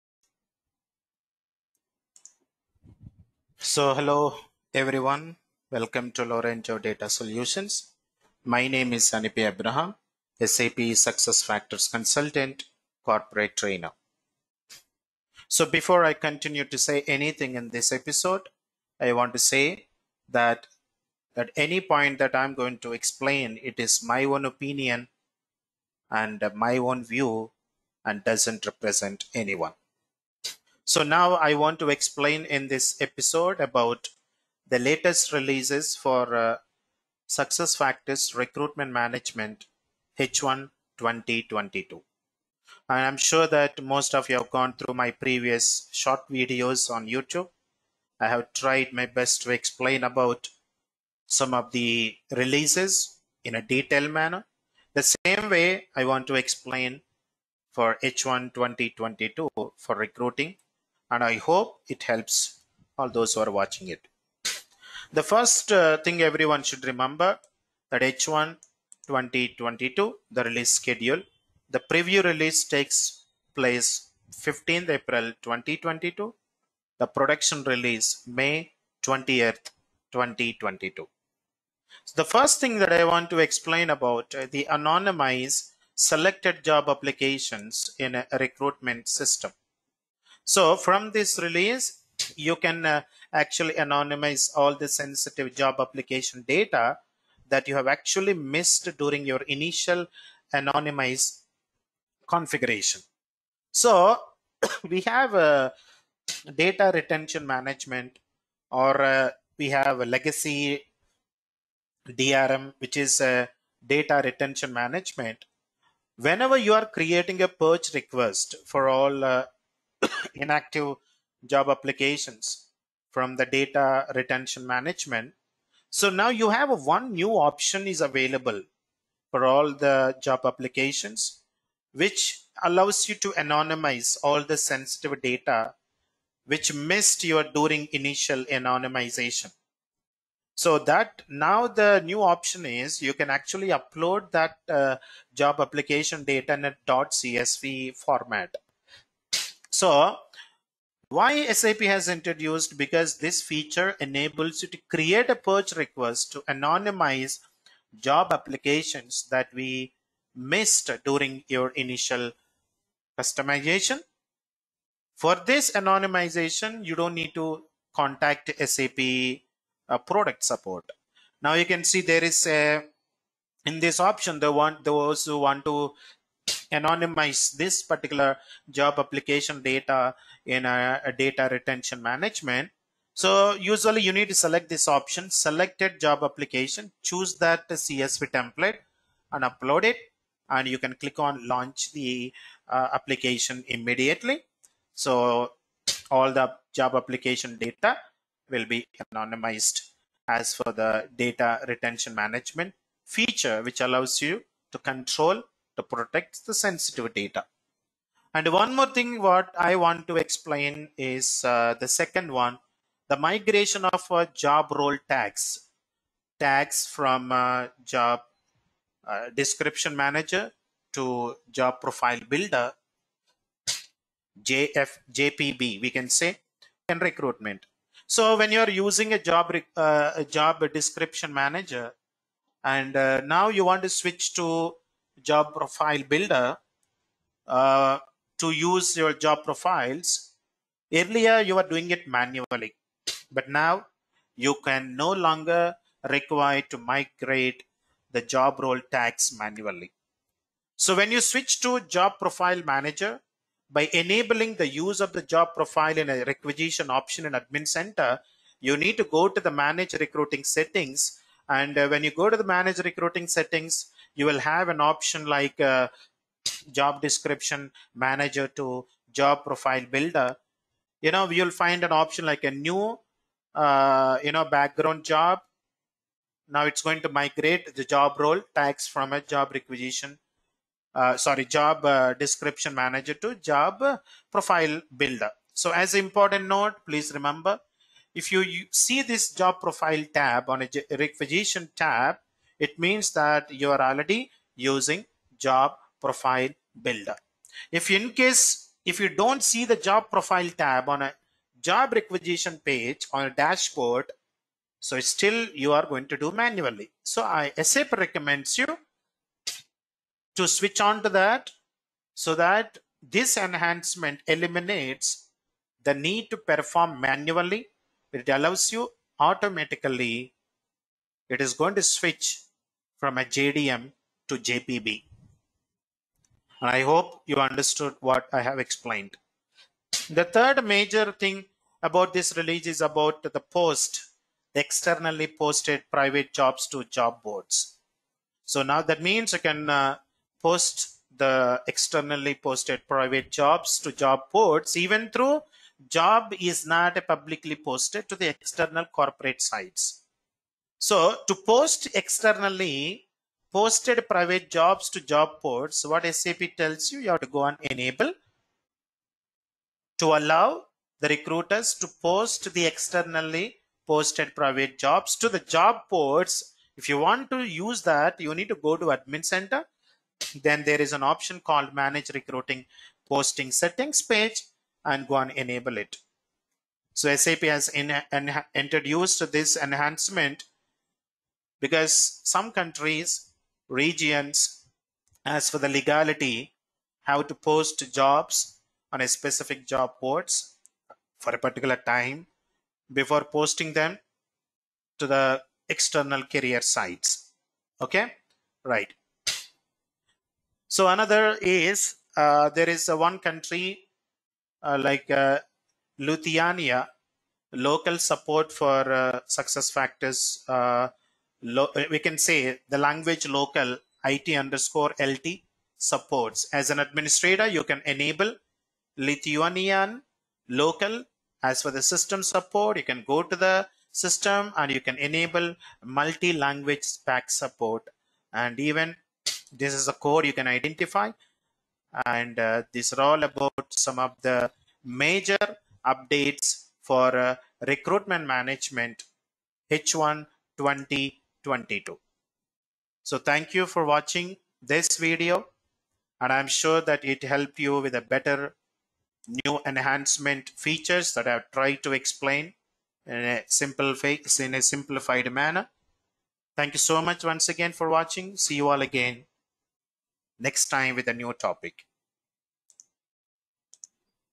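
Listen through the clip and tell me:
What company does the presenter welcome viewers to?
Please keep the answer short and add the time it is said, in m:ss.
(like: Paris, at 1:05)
Lorenzo Data Solutions, at 0:06.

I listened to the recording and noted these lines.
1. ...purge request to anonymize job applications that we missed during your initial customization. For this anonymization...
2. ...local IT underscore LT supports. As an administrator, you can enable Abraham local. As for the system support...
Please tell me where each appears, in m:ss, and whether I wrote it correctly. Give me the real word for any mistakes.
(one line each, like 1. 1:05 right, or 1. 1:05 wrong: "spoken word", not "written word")
1. 2:35 right
2. 6:53 wrong: "Lithuanian", not "Abraham".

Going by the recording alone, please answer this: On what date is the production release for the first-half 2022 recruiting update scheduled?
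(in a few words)
May 20th, 2022.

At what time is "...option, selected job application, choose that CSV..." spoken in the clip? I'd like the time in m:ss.
3:04.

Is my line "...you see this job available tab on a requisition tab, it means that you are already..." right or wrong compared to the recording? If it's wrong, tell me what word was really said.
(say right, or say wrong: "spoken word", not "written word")
wrong: "profile", not "available".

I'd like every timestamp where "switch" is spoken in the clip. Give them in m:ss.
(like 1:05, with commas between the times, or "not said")
3:53, 4:11, 5:10, 5:21.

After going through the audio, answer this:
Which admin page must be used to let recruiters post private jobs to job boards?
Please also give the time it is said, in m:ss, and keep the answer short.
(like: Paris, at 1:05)
manage recruiting posting settings, at 6:11.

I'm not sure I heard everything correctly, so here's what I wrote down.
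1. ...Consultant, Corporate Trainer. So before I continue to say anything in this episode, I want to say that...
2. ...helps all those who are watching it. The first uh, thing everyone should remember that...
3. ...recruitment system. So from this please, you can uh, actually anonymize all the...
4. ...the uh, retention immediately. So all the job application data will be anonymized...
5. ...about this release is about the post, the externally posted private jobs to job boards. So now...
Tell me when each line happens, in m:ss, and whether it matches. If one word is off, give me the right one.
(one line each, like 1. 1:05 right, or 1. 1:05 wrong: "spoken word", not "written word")
1. 0:11 right
2. 1:02 right
3. 1:28 wrong: "release", not "please"
4. 3:11 wrong: "application", not "retention"
5. 5:31 right.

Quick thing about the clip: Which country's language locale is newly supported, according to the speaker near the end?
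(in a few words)
Lithuania.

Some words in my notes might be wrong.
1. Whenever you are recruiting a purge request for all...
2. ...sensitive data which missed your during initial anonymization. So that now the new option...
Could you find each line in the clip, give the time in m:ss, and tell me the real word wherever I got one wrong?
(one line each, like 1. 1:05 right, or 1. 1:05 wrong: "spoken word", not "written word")
1. 1:56 wrong: "creating", not "recruiting"
2. 2:14 right.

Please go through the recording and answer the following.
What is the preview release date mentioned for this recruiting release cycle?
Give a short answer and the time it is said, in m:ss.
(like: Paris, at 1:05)
15th April 2022, at 1:14.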